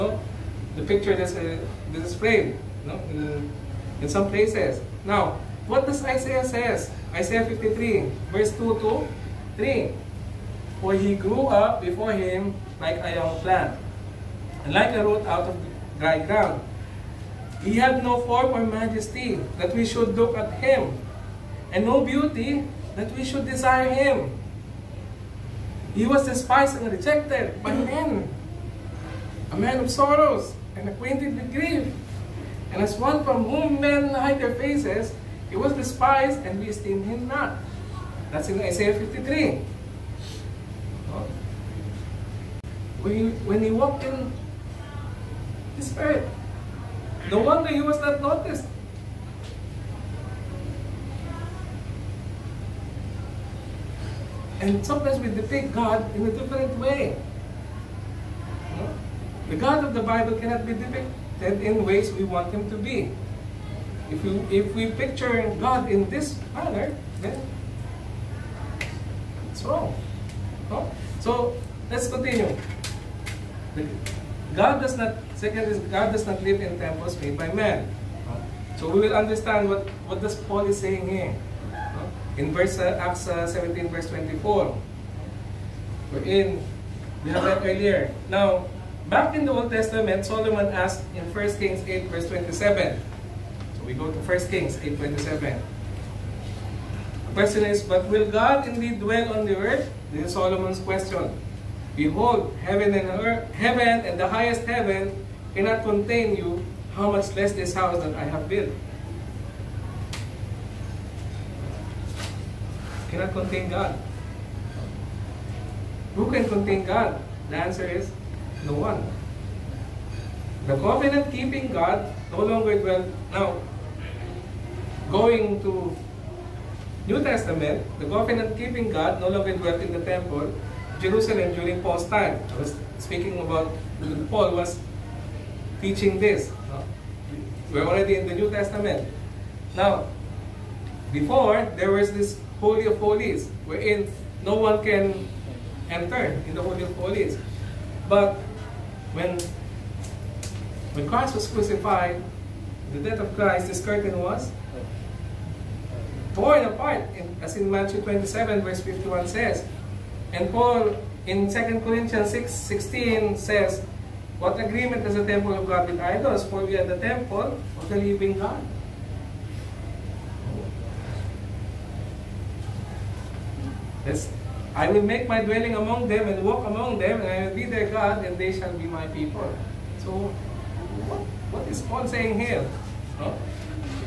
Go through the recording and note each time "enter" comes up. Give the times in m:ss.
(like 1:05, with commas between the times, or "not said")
2:25.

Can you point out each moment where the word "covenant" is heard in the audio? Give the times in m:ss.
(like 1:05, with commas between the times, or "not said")
2:00, 2:08.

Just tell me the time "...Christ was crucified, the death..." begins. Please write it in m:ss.
2:31.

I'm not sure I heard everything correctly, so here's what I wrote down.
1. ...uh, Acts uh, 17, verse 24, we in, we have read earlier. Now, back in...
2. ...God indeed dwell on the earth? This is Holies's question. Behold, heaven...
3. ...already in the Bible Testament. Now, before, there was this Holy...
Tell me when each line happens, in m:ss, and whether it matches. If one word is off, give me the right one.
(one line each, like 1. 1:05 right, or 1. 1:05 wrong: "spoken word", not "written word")
1. 1:22 right
2. 1:38 wrong: "Solomon", not "Holies"
3. 2:17 wrong: "New", not "Bible".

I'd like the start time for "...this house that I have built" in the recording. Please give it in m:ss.
1:47.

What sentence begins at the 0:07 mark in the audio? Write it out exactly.
Isaiah 53, verse 2 to 3.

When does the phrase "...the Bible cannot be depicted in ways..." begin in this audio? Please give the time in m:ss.
0:59.